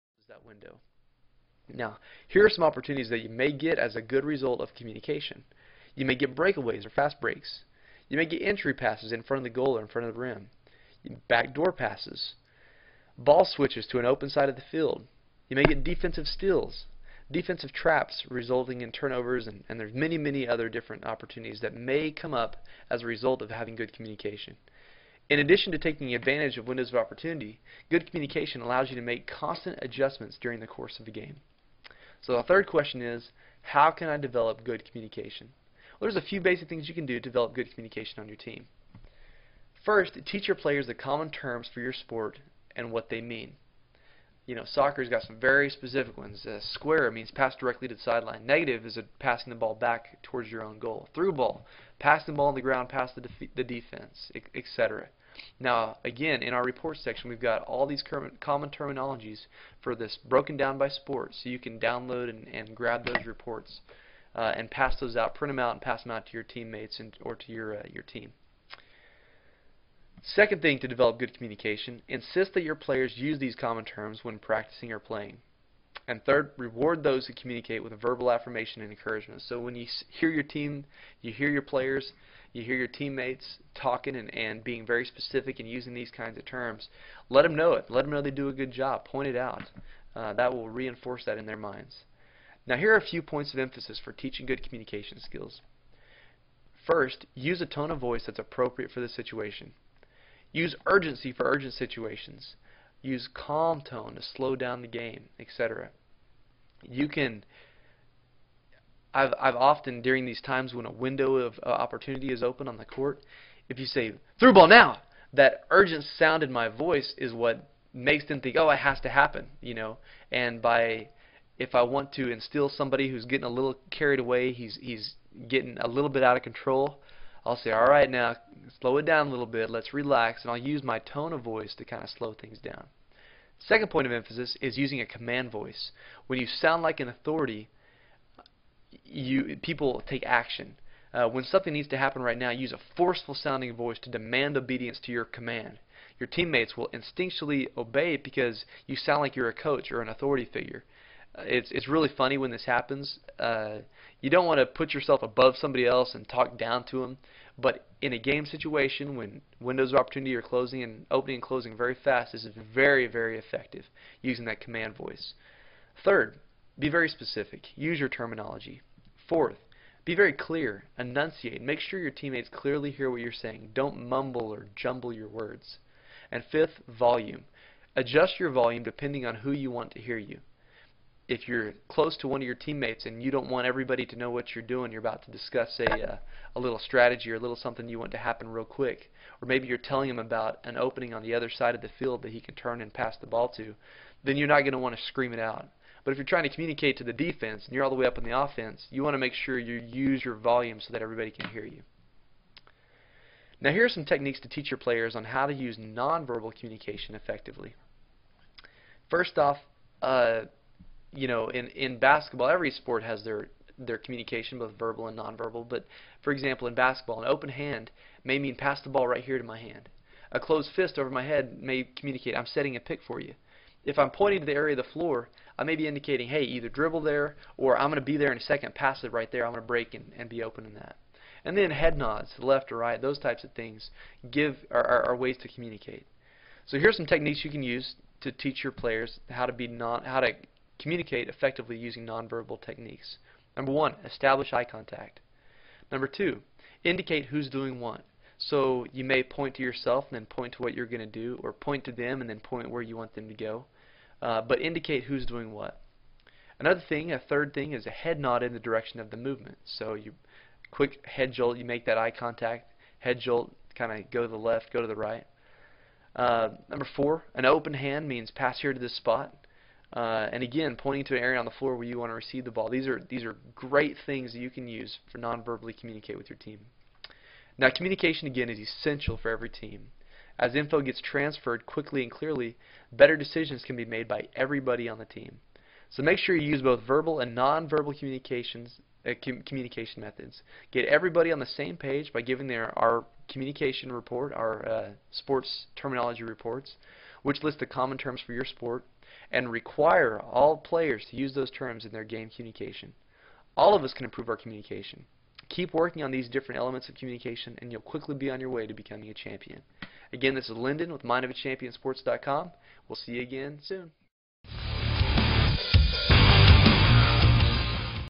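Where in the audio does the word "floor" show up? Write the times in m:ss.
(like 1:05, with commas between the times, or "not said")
3:44, 4:31.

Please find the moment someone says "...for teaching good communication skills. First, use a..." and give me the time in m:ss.
1:34.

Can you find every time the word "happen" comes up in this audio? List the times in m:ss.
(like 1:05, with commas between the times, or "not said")
1:59, 2:21, 2:32, 3:08.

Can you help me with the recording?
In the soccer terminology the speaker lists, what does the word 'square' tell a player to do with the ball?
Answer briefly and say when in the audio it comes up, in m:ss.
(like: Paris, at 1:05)
Pass directly to the sideline, at 0:47.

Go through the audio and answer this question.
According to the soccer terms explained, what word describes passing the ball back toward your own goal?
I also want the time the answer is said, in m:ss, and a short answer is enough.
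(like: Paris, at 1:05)
Negative, at 0:48.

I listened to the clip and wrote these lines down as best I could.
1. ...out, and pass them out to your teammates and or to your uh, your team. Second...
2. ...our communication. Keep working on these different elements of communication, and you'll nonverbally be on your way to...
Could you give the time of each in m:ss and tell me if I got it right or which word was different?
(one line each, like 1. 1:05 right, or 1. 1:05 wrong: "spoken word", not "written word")
1. 1:05 right
2. 5:04 wrong: "quickly", not "nonverbally".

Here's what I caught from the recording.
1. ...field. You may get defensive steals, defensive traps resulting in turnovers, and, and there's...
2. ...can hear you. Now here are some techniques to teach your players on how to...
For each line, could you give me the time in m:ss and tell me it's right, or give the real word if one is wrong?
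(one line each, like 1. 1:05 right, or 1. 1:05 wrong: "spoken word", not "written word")
1. 0:14 right
2. 3:21 right.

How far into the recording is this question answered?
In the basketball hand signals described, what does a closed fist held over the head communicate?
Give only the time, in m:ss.
3:42.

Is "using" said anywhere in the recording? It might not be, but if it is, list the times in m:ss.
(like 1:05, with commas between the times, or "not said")
1:25, 2:14, 2:44, 4:01.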